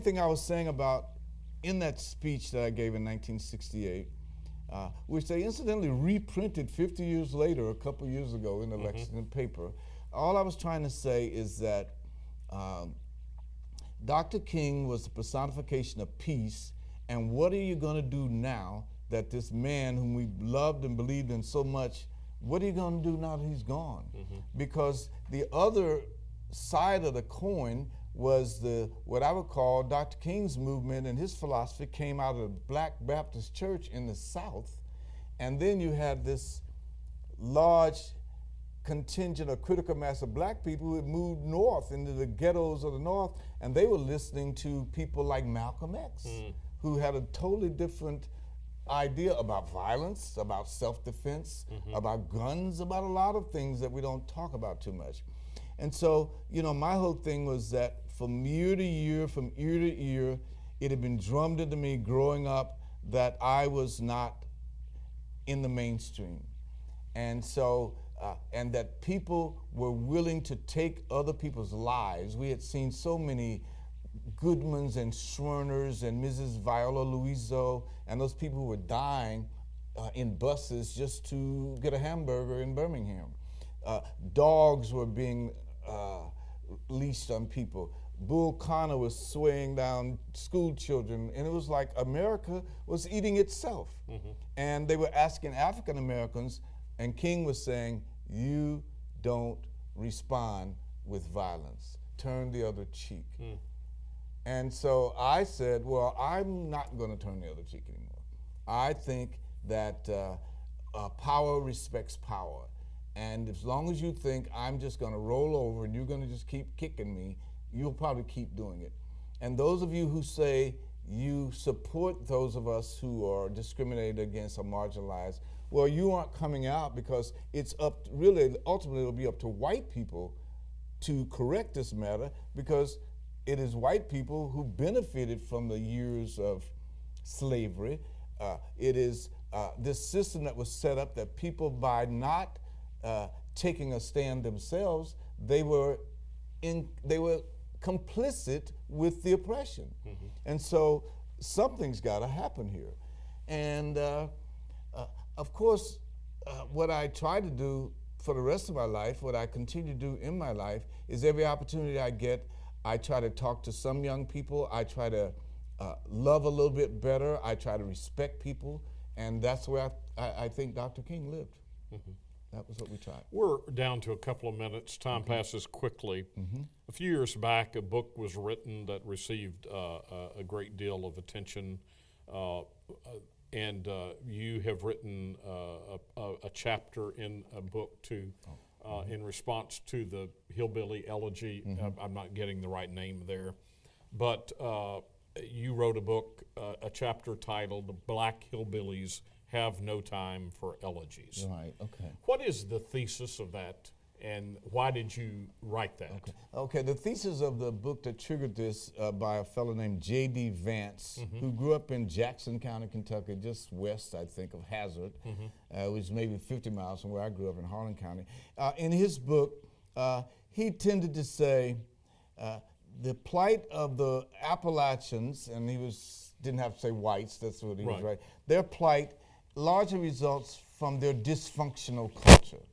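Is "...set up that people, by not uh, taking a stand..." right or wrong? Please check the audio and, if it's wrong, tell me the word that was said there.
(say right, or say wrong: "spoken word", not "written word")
right.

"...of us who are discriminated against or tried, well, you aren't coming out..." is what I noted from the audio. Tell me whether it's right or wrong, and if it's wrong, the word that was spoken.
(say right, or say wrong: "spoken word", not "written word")
wrong: "marginalized", not "tried".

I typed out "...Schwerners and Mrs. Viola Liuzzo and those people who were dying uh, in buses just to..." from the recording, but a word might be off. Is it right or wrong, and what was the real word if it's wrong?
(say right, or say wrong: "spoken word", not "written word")
right.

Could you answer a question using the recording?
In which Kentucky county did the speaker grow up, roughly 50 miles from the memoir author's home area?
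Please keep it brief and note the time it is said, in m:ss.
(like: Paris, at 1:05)
Harlan County, at 3:37.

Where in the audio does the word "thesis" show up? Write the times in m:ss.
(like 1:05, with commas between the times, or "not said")
3:22, 3:26.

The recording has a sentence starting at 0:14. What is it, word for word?
King was the personification of peace.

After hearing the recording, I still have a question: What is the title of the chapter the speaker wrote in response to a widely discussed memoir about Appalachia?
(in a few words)
Black Hillbillies Have No Time for Elegies.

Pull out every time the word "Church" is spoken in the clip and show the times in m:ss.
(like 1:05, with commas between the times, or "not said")
0:33.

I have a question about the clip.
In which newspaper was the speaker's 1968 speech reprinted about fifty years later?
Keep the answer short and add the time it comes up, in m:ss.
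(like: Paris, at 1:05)
Lexington paper, at 0:08.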